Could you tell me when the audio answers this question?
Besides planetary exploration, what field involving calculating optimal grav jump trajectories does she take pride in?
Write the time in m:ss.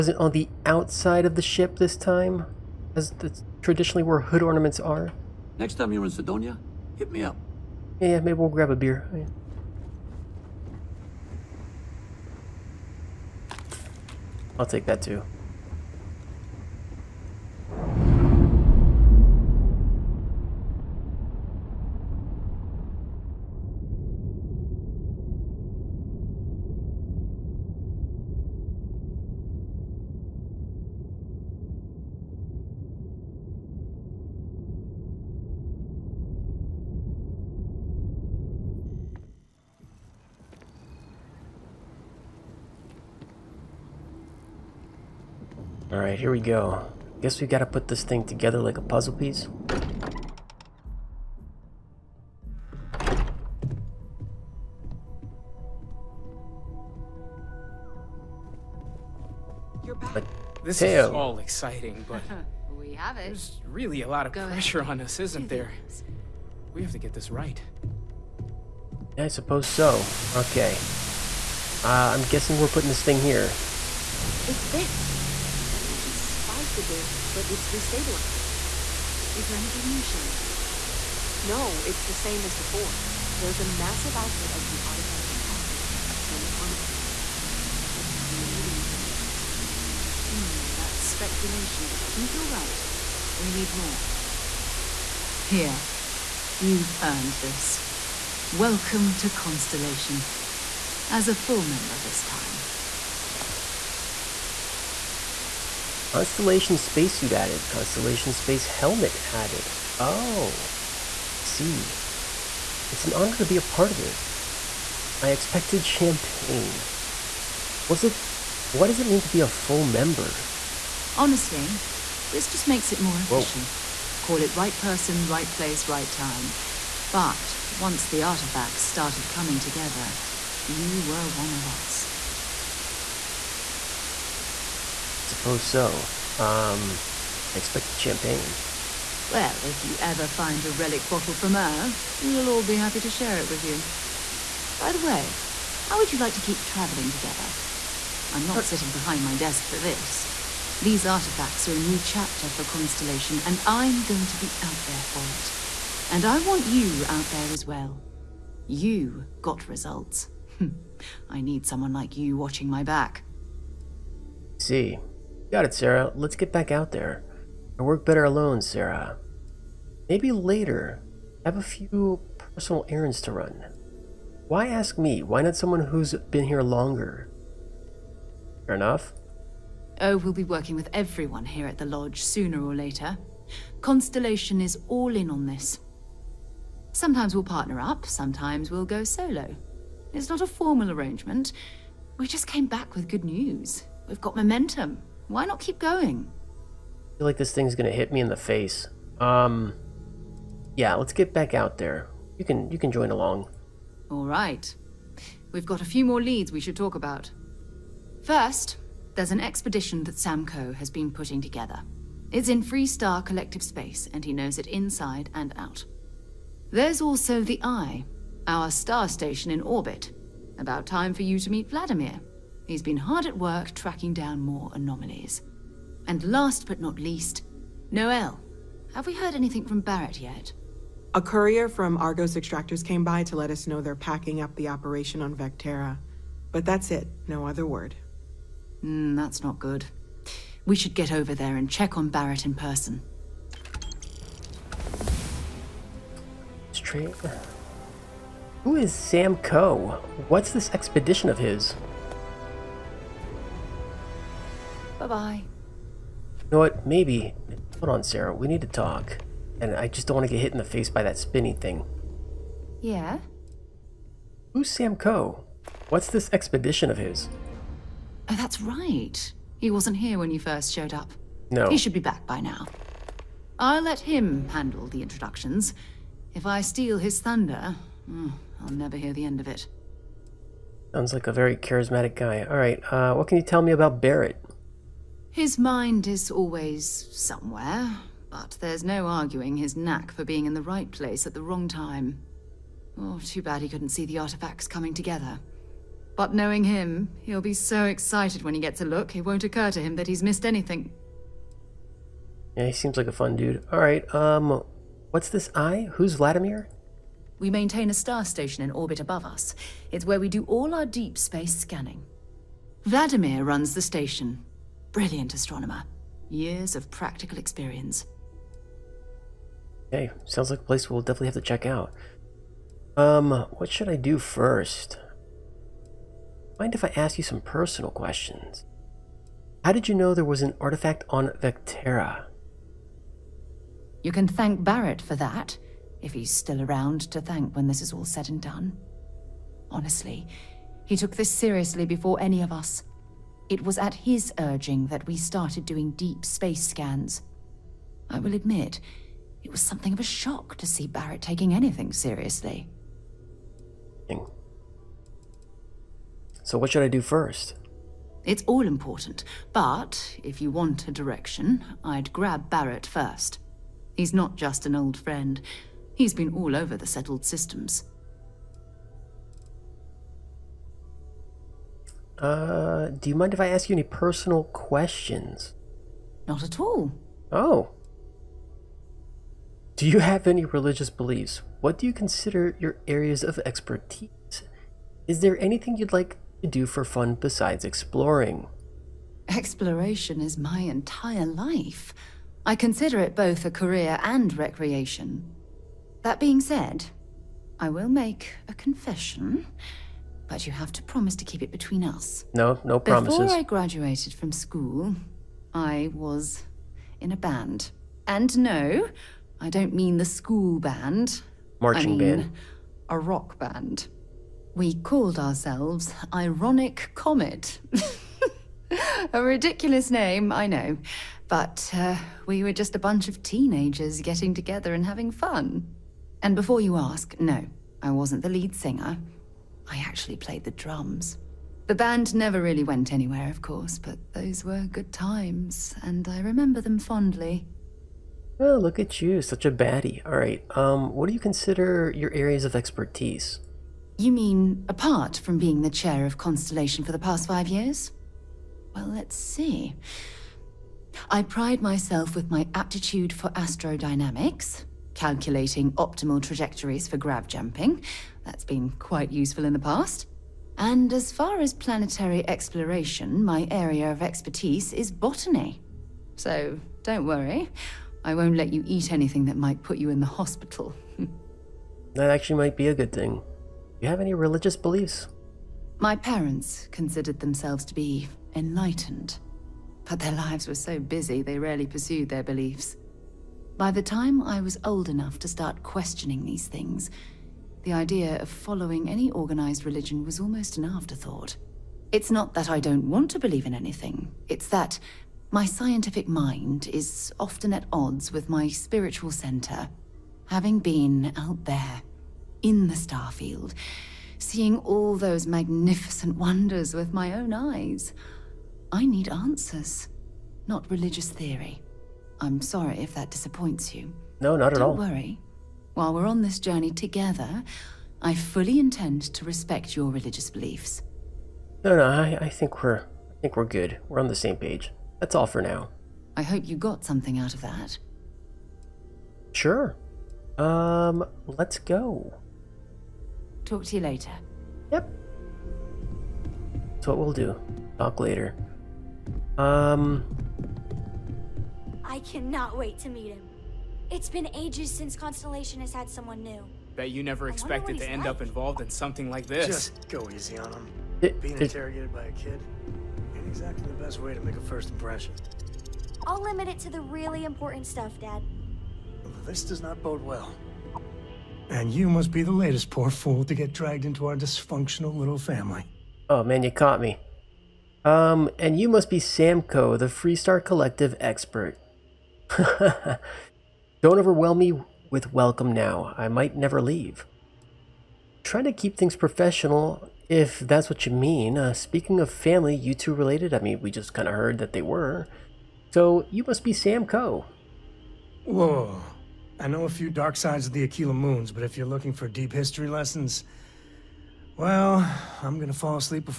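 7:33.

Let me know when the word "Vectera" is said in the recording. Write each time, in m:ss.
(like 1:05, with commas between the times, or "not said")
3:55, 5:31.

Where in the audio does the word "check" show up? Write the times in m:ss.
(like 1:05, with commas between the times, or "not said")
4:01, 5:21.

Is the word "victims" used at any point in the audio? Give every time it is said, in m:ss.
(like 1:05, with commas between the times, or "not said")
not said.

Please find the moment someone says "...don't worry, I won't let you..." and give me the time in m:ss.
7:46.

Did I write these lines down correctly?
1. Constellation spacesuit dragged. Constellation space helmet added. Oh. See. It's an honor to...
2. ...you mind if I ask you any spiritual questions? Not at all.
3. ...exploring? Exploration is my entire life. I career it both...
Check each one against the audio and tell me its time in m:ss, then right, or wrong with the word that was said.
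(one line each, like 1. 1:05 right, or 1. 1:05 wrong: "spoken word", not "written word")
1. 1:46 wrong: "added", not "dragged"
2. 6:13 wrong: "personal", not "spiritual"
3. 6:27 wrong: "consider", not "career".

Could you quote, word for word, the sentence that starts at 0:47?
Guess we gotta put this thing together like a puzzle piece.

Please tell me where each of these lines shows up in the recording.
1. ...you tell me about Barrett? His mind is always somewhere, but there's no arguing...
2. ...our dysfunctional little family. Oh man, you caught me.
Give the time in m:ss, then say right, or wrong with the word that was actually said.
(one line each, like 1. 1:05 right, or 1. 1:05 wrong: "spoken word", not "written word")
1. 4:43 right
2. 9:24 right.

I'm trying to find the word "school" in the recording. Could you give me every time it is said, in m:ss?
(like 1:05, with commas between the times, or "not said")
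6:44, 6:50.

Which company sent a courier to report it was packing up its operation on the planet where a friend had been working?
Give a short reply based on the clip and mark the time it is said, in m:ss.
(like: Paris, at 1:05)
Argos Extractors, at 3:51.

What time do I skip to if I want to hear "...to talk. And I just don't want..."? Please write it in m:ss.
4:18.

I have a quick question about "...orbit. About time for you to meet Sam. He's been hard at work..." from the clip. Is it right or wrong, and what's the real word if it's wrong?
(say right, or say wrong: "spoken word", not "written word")
wrong: "Vladimir", not "Sam".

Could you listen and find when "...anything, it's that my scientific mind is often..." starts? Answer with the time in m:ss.
8:13.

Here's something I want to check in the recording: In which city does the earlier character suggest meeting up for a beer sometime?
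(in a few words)
Cydonia.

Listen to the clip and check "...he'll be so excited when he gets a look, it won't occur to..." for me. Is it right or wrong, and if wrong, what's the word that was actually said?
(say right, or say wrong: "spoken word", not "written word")
right.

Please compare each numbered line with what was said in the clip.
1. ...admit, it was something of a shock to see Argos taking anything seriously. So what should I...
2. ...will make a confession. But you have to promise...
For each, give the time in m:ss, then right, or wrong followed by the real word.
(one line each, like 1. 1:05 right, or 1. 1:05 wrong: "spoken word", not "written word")
1. 5:48 wrong: "Barrett", not "Argos"
2. 6:37 right.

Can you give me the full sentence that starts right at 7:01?
But uh, we were just a bunch of teenagers getting together and having fun.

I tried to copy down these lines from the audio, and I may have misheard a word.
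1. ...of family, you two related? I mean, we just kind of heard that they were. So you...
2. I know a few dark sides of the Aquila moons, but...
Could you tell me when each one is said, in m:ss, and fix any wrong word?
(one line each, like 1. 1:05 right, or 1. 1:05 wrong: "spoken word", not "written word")
1. 9:42 right
2. 9:49 right.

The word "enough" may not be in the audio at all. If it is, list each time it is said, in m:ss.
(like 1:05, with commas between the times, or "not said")
2:58, 8:04.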